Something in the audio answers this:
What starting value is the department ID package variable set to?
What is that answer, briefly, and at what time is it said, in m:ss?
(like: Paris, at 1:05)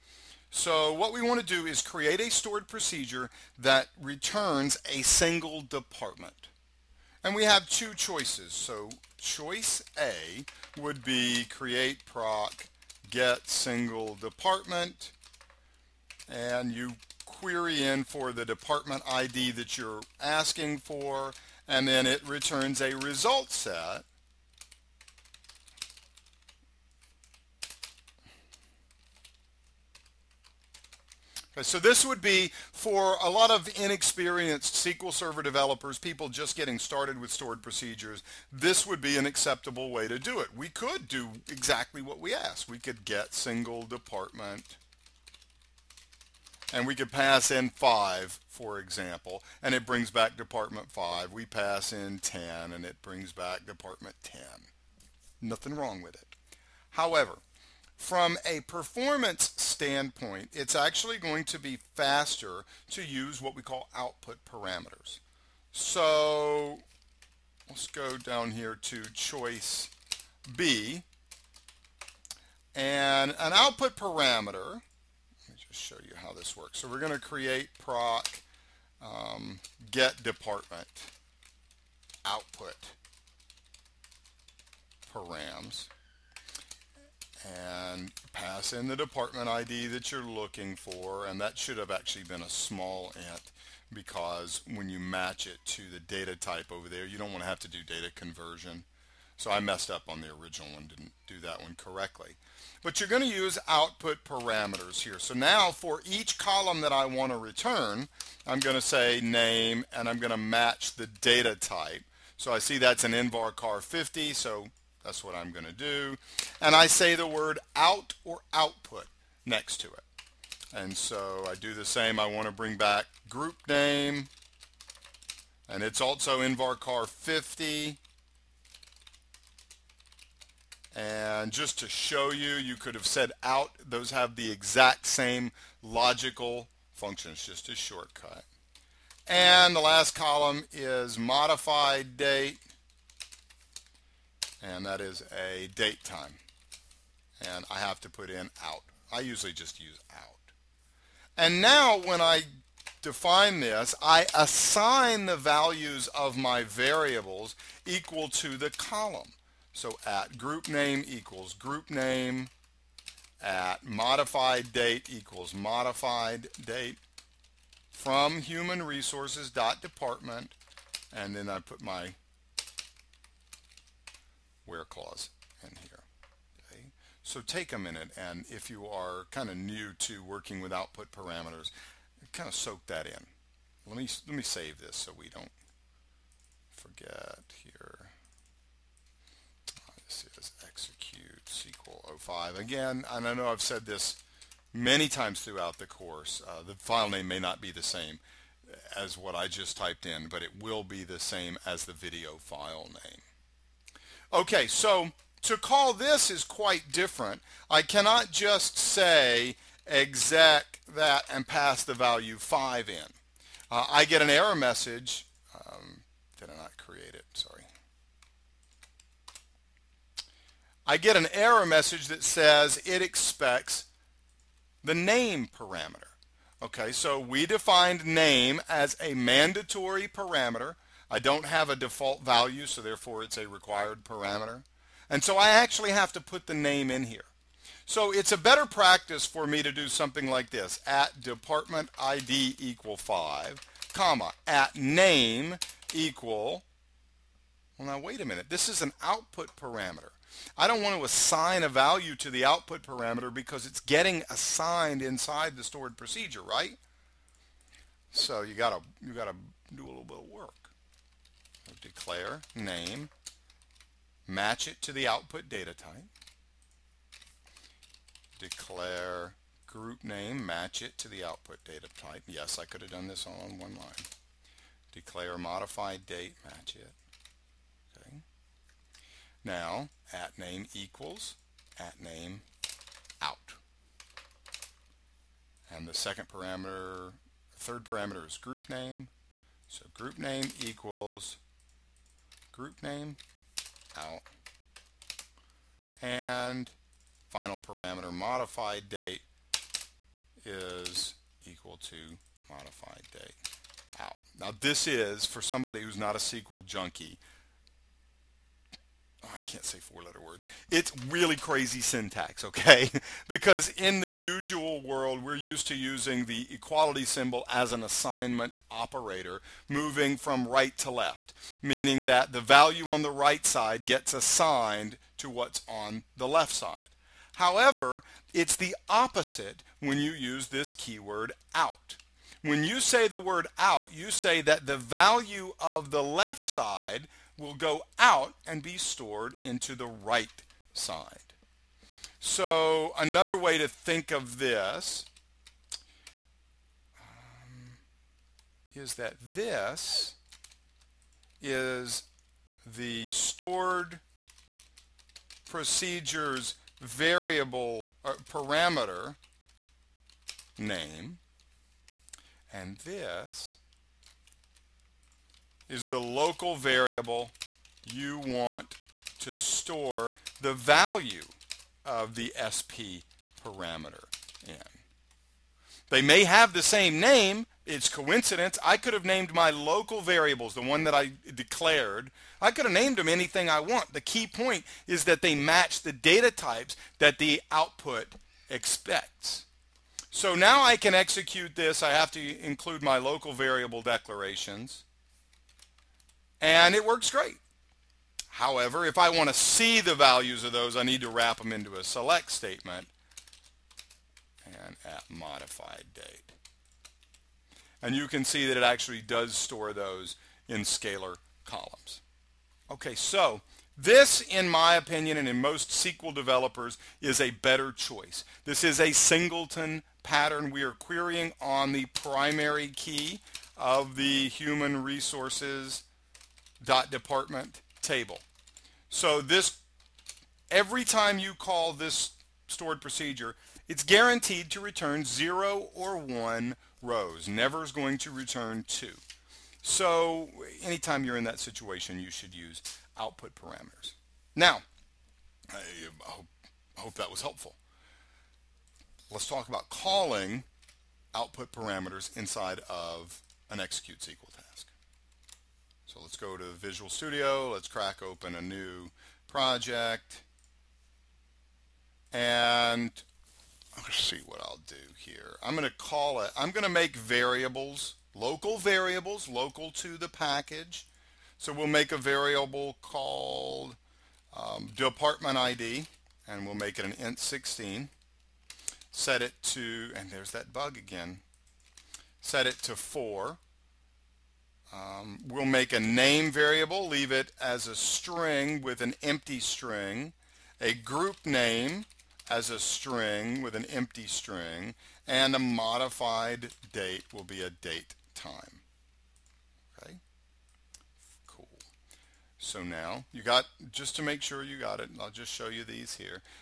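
4, at 8:02.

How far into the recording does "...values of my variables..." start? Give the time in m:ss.
2:35.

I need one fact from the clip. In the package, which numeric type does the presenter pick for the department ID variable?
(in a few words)
int 16.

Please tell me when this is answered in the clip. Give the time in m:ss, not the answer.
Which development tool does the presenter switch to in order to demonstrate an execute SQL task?
7:36.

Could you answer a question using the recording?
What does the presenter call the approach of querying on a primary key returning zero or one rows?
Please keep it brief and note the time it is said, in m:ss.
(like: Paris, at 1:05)
singleton pattern, at 6:58.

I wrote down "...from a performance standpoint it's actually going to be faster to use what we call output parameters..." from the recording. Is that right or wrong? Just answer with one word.
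right.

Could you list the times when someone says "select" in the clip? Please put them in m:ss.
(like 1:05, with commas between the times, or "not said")
6:41.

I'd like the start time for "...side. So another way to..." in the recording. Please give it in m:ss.
5:40.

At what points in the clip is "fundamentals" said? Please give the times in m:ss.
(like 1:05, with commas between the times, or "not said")
not said.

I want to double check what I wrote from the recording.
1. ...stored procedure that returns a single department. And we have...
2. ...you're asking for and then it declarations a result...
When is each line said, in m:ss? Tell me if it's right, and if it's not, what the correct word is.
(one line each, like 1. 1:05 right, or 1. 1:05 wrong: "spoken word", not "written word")
1. 0:02 right
2. 0:19 wrong: "returns", not "declarations".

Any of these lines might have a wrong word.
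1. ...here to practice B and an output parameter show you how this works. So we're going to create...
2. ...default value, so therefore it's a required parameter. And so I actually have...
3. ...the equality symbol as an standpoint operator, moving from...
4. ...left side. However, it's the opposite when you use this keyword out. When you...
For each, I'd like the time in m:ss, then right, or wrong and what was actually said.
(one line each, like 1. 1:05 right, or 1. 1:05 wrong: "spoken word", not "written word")
1. 1:08 wrong: "choice", not "practice"
2. 3:51 right
3. 5:16 wrong: "assignment", not "standpoint"
4. 5:26 right.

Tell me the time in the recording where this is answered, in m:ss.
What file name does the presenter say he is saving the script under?
3:10.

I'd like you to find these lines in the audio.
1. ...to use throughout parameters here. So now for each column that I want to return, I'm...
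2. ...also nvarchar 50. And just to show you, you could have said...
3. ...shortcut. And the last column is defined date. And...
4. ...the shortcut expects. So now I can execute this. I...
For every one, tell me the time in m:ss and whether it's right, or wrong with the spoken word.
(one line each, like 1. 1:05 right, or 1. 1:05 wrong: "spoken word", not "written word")
1. 1:43 wrong: "output", not "throughout"
2. 2:06 right
3. 2:17 wrong: "modified", not "defined"
4. 6:27 wrong: "output", not "shortcut".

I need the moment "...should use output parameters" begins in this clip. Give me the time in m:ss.
7:22.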